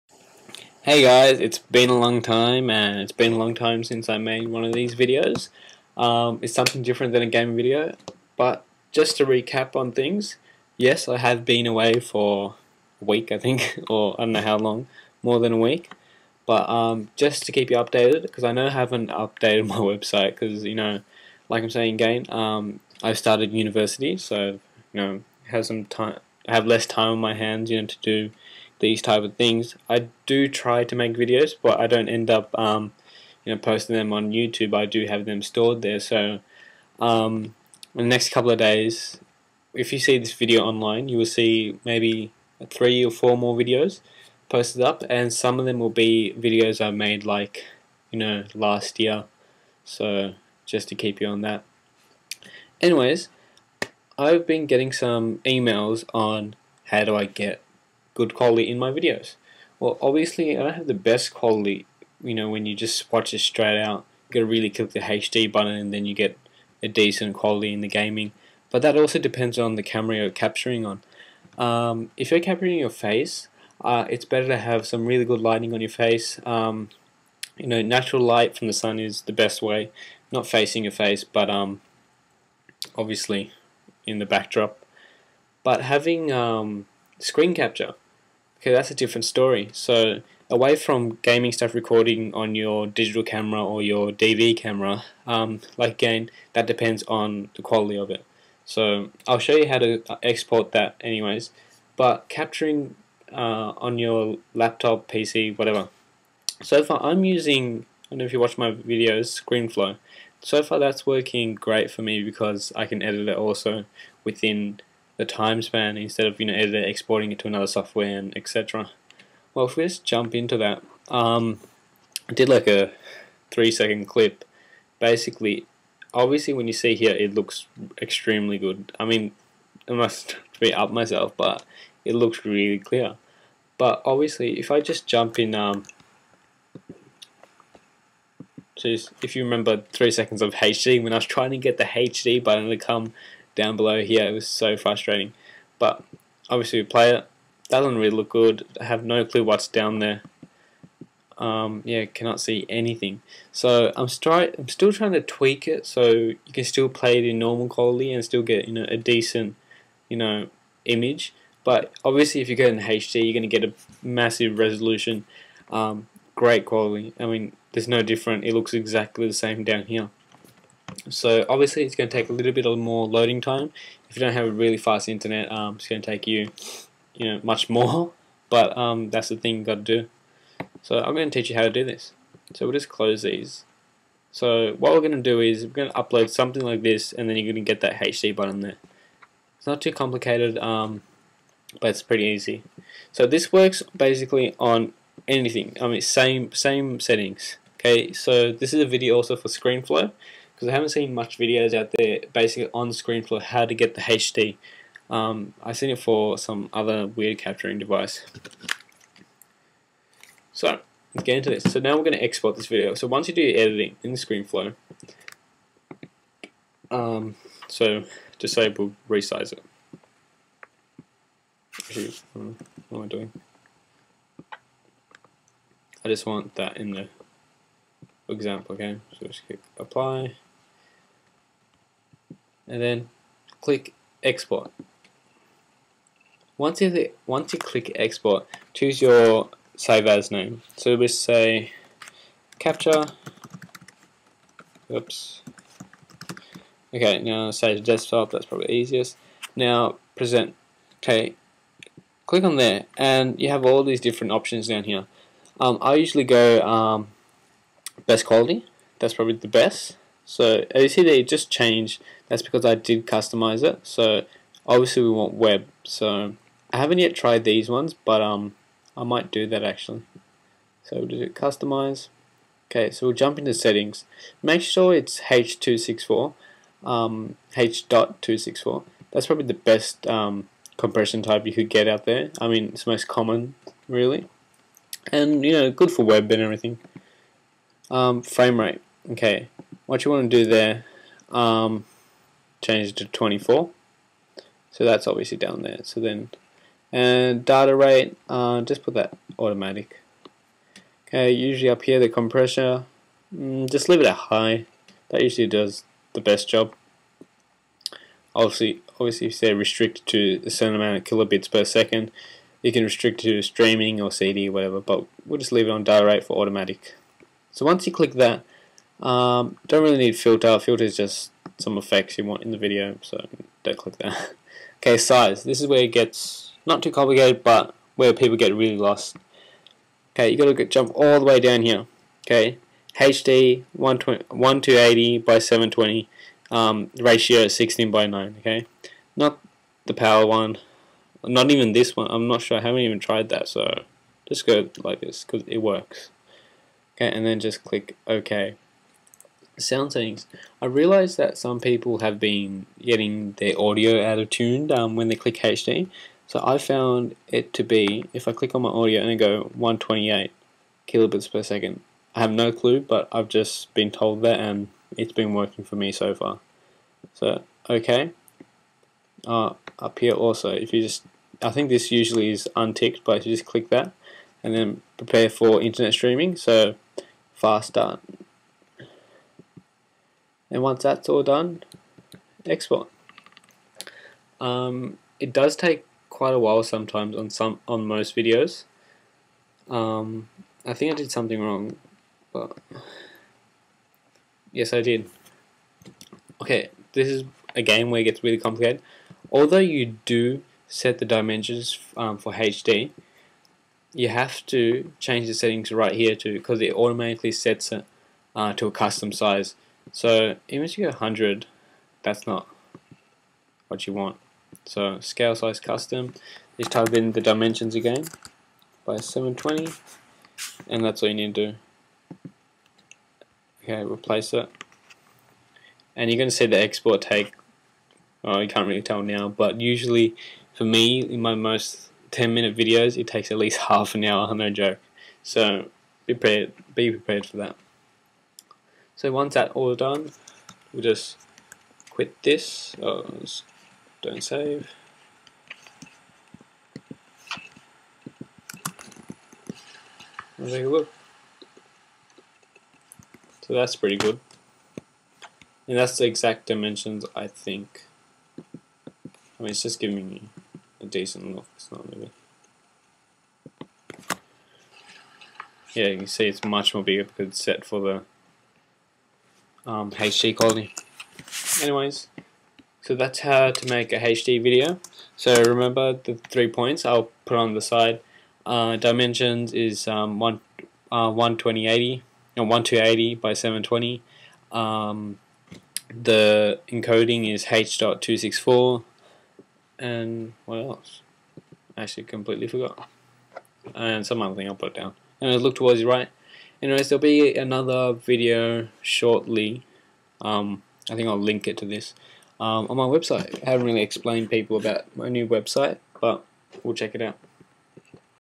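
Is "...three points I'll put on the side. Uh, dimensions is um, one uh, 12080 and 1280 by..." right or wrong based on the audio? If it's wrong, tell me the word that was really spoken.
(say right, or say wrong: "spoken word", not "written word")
right.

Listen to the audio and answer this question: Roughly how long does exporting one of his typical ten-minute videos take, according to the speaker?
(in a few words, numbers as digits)
Half an hour.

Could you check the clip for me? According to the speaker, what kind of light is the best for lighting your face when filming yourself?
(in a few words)
Natural light from the sun.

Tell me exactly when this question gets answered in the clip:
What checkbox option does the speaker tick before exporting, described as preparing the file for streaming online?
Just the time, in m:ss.
6:14.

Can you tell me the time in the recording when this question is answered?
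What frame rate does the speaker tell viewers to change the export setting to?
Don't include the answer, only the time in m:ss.
4:53.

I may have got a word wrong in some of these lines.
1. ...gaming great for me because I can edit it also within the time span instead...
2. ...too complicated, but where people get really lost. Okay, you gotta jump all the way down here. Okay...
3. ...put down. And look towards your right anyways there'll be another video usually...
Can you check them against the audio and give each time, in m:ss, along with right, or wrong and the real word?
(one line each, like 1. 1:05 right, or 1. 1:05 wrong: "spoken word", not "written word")
1. 1:51 wrong: "working", not "gaming"
2. 5:26 right
3. 8:14 wrong: "shortly", not "usually".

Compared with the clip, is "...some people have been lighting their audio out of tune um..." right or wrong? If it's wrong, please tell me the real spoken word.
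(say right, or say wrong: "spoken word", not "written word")
wrong: "getting", not "lighting".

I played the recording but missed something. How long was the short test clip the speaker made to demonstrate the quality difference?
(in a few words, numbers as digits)
3 seconds.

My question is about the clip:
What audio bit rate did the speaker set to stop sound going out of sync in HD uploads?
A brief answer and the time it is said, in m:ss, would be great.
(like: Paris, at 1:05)
128 kilobits per second, at 5:59.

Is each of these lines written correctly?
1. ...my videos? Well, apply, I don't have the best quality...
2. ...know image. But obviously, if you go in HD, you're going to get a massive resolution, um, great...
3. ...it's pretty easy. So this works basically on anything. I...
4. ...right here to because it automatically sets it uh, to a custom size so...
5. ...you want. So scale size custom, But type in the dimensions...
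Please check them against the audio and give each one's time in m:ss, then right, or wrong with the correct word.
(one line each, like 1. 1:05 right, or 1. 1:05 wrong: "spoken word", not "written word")
1. 0:58 wrong: "obviously", not "apply"
2. 2:40 right
3. 3:11 right
4. 6:45 right
5. 6:53 wrong: "Just", not "But".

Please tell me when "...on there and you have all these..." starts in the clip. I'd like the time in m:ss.
4:12.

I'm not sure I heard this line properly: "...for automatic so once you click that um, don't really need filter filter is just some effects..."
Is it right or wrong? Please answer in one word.
right.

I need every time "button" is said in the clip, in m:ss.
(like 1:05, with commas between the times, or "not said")
1:05, 2:22, 3:08.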